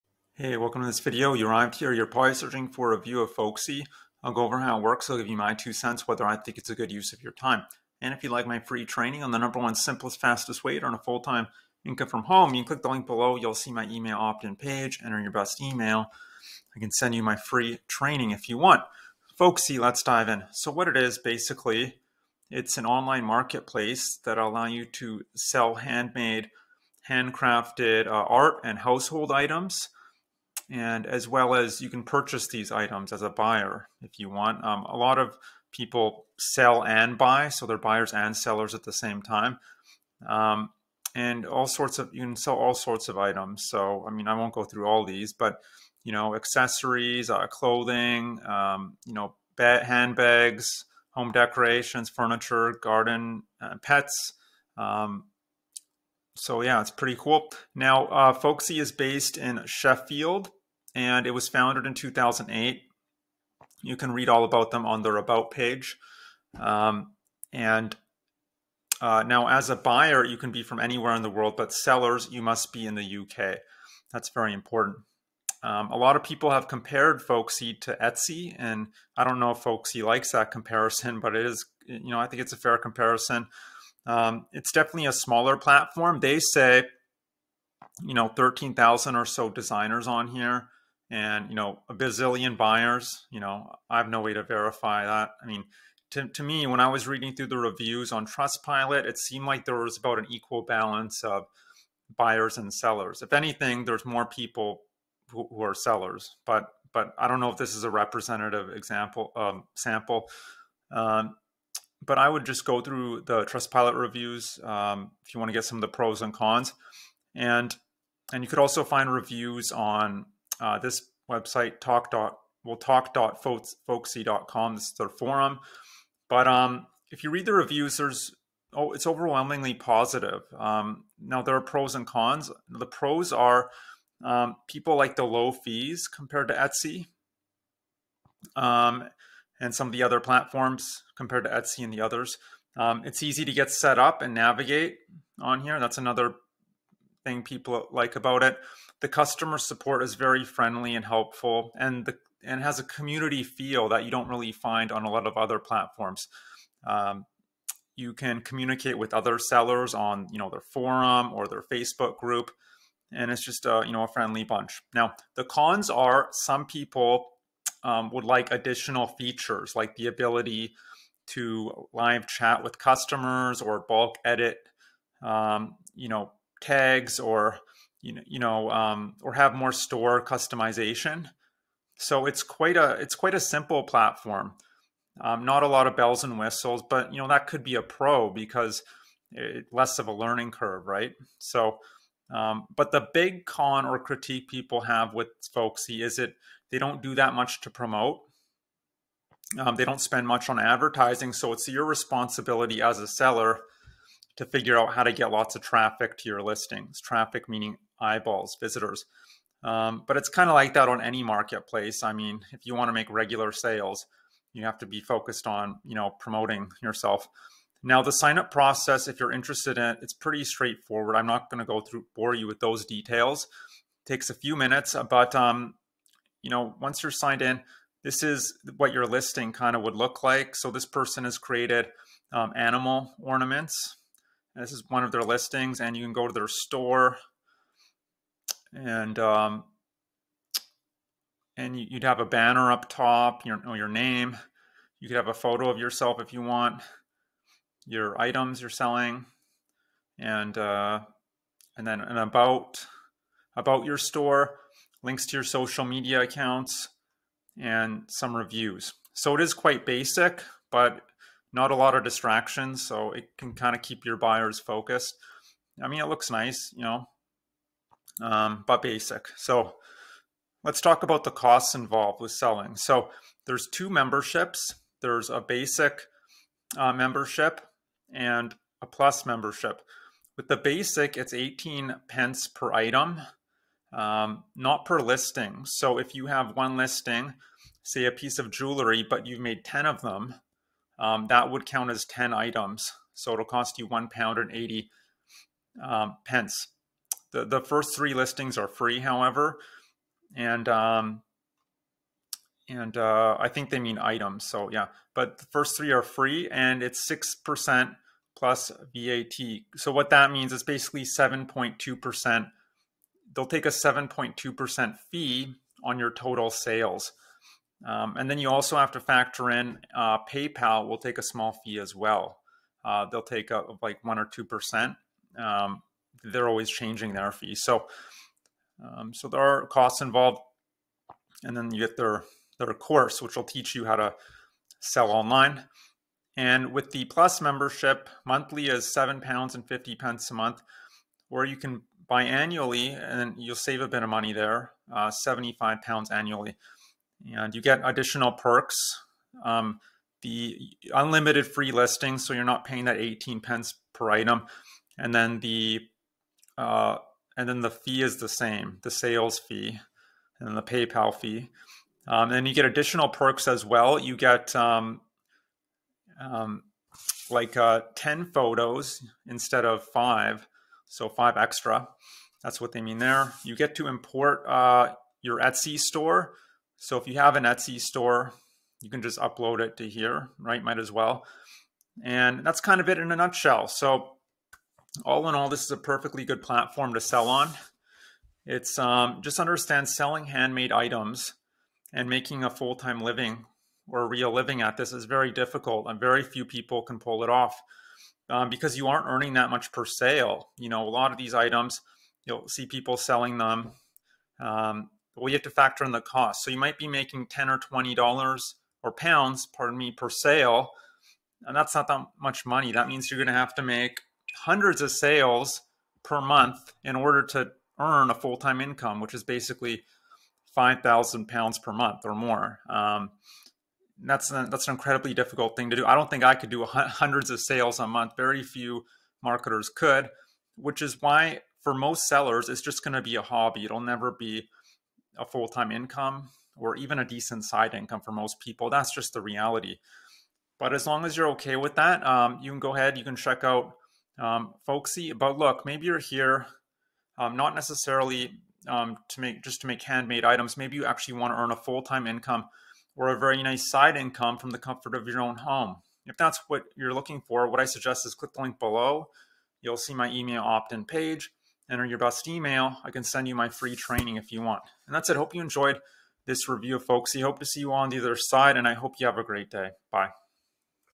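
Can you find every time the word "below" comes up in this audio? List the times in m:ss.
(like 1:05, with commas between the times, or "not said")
0:13, 7:38.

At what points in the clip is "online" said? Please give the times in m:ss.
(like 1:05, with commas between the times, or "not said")
0:22, 5:35.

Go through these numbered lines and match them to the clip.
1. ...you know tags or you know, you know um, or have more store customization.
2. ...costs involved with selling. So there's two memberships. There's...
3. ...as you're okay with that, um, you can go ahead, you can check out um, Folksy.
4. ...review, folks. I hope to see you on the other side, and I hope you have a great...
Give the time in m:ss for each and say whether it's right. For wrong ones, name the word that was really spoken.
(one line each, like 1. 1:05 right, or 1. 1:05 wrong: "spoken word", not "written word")
1. 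2:55 right
2. 4:31 right
3. 7:21 right
4. 7:46 right.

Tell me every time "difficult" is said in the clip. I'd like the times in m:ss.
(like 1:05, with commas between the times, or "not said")
6:35, 7:05.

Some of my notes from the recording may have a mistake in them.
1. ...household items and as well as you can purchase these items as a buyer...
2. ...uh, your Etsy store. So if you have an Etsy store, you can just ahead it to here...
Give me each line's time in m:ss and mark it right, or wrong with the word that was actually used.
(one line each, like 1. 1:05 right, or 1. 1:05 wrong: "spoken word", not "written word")
1. 0:28 right
2. 6:14 wrong: "upload", not "ahead".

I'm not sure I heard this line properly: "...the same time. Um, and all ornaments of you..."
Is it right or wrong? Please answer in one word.
wrong.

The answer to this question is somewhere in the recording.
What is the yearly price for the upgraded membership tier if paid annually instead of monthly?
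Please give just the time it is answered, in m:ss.
5:45.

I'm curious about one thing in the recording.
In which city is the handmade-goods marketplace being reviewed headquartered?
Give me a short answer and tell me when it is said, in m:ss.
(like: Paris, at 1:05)
Sheffield, at 0:59.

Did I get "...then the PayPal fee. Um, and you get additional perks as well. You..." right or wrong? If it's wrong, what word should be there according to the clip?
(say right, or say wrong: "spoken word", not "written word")
right.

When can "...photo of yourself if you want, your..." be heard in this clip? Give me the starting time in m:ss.
4:05.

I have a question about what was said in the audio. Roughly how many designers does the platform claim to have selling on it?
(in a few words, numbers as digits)
13,000.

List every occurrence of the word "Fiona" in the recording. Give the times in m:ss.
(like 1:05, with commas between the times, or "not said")
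not said.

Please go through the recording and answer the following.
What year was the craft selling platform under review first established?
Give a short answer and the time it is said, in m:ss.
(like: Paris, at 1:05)
2008, at 1:01.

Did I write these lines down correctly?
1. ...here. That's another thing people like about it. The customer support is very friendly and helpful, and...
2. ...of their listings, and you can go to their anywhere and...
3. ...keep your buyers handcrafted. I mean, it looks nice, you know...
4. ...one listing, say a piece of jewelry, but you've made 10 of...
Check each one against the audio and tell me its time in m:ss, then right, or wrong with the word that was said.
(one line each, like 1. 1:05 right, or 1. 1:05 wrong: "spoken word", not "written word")
1. 2:25 right
2. 3:55 wrong: "store", not "anywhere"
3. 4:23 wrong: "focused", not "handcrafted"
4. 4:46 right.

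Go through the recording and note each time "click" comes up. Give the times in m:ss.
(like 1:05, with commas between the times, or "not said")
0:12, 7:38.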